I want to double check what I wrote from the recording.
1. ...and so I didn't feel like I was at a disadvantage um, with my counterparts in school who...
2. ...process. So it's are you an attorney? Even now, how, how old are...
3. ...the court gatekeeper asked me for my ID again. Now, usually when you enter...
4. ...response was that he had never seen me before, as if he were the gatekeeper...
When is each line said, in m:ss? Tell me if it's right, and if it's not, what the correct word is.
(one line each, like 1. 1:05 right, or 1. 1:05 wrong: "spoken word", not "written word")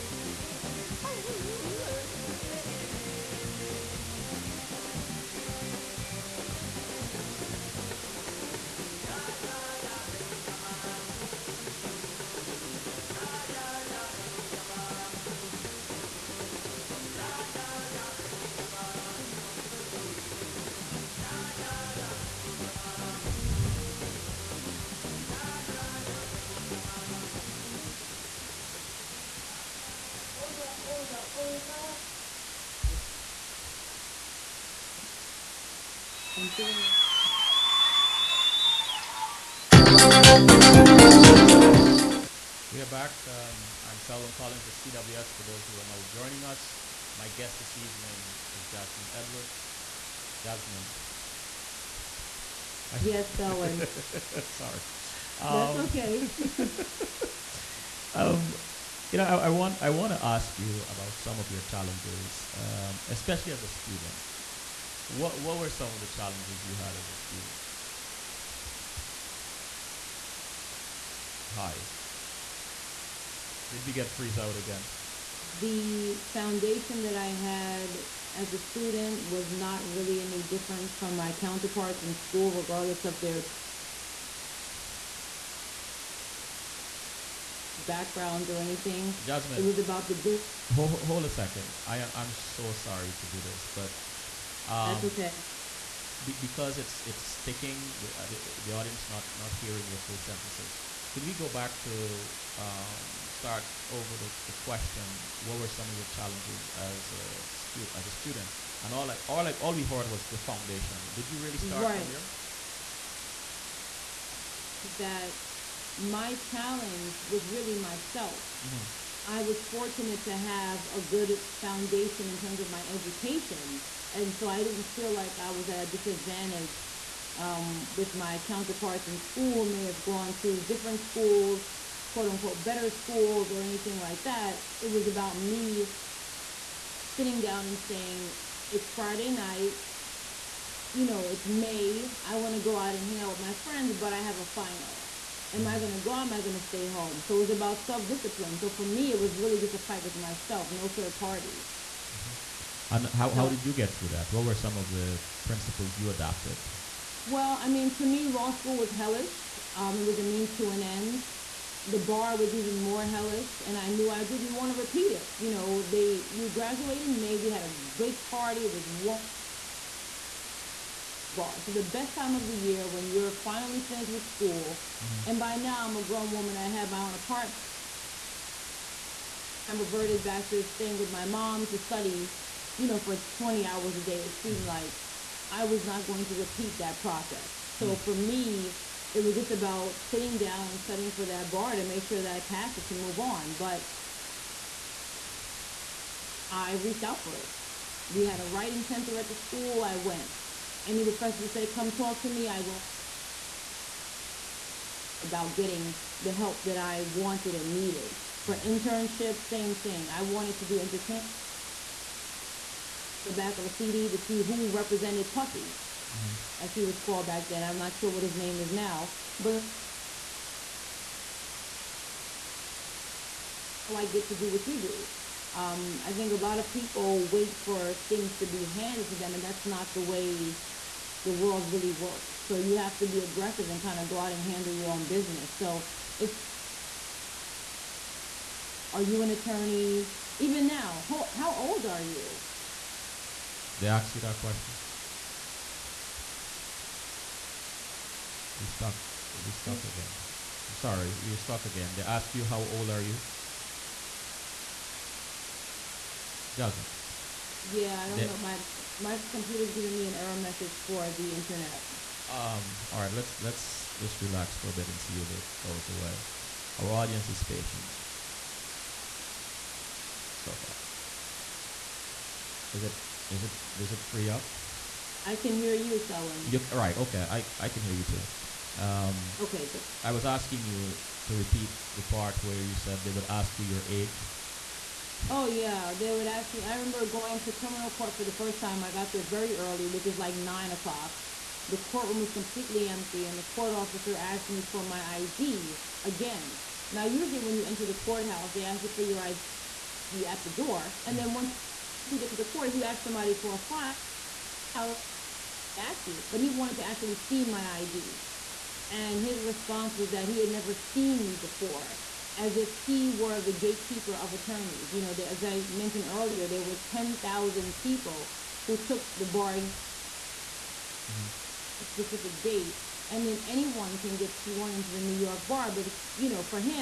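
1. 2:04 right
2. 3:55 wrong: "business", not "process"
3. 4:53 wrong: "officer", not "gatekeeper"
4. 5:09 right.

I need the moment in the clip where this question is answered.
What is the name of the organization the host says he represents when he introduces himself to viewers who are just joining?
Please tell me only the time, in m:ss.
0:44.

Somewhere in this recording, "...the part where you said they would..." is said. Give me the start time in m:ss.
4:41.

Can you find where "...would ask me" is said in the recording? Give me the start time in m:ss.
4:46.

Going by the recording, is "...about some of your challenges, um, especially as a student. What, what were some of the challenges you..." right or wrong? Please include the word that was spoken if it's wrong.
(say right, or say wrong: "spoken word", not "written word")
right.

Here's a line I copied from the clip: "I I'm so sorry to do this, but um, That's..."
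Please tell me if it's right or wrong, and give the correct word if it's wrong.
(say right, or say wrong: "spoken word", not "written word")
right.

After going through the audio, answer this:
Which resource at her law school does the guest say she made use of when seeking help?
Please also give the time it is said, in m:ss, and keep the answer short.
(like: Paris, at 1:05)
Writing center, at 3:18.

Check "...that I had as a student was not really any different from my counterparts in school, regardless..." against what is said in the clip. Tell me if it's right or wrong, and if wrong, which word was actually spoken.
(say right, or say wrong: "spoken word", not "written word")
right.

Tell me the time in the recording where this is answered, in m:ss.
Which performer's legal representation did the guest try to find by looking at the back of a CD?
3:35.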